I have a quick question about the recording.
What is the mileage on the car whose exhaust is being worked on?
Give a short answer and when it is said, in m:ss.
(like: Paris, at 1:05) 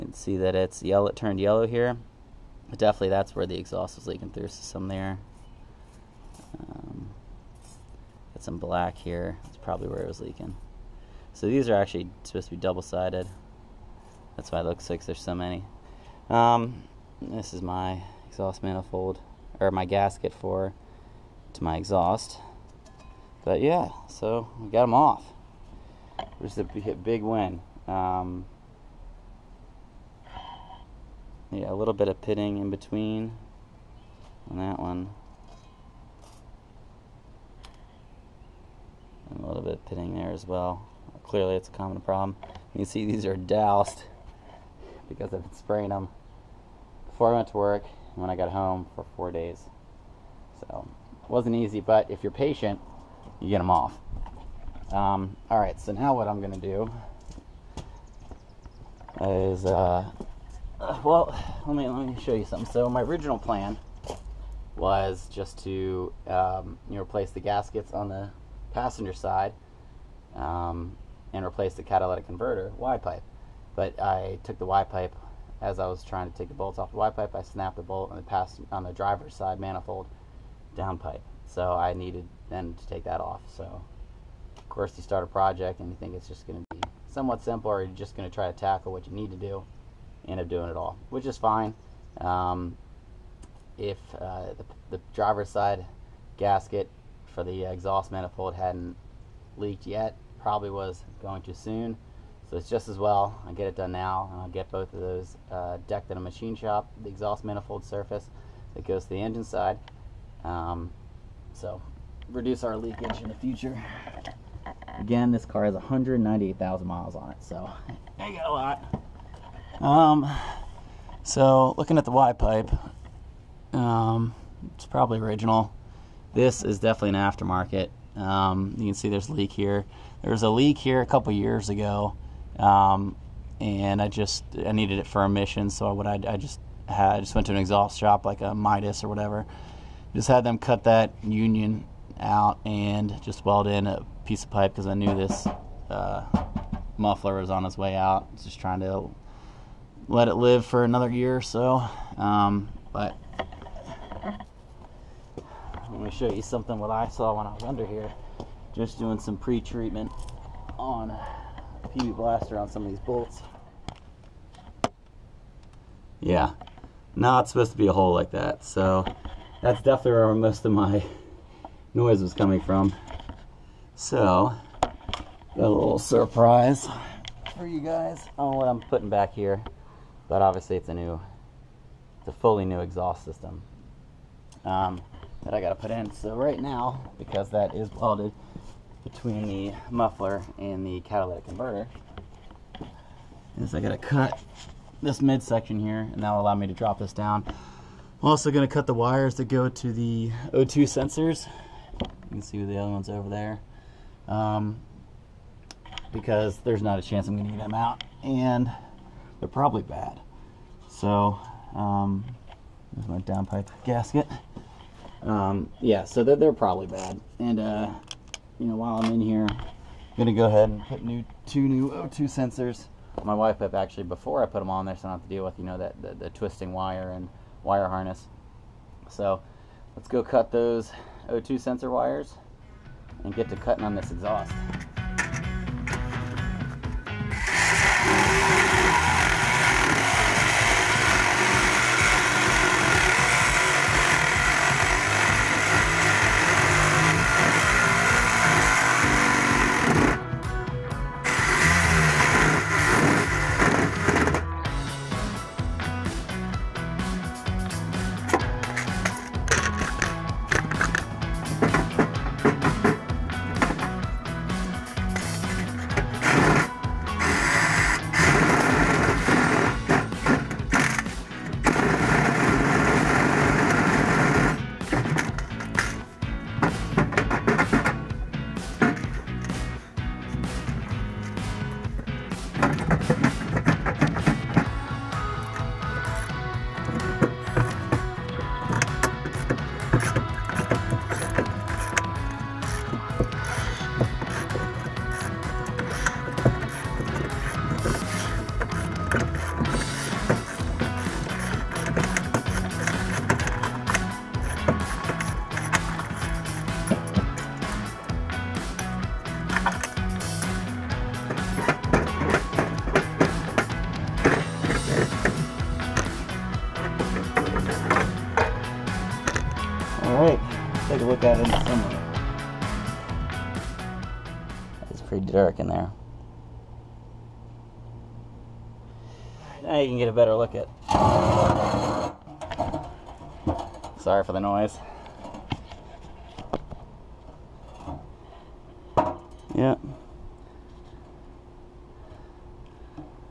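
198,000, at 1:55.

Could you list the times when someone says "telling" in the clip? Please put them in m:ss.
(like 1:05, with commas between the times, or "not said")
not said.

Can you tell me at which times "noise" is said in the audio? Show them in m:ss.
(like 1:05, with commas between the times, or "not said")
2:51, 5:34.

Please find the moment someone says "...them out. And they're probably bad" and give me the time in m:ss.
3:27.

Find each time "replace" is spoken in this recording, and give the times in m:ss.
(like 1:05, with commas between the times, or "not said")
1:07, 1:11.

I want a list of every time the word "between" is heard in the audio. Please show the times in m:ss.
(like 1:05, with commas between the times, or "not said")
0:32, 3:09.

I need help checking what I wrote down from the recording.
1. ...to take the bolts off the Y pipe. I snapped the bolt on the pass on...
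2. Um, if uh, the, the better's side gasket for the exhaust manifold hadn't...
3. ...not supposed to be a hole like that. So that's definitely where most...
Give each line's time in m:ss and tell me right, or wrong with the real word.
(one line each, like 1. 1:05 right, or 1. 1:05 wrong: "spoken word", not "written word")
1. 1:16 right
2. 1:32 wrong: "driver", not "better"
3. 2:47 right.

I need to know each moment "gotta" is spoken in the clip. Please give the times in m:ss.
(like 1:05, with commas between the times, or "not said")
3:05, 3:13.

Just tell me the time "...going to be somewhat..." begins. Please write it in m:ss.
1:26.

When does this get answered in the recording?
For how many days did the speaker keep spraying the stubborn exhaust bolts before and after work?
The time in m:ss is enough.
0:49.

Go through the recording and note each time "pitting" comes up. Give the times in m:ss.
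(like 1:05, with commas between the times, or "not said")
0:32, 0:39.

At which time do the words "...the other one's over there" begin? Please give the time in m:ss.
3:22.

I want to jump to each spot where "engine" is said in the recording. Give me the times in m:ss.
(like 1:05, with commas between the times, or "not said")
1:49.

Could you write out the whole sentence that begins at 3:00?
But obviously it's a new, it's a fully new exhaust system.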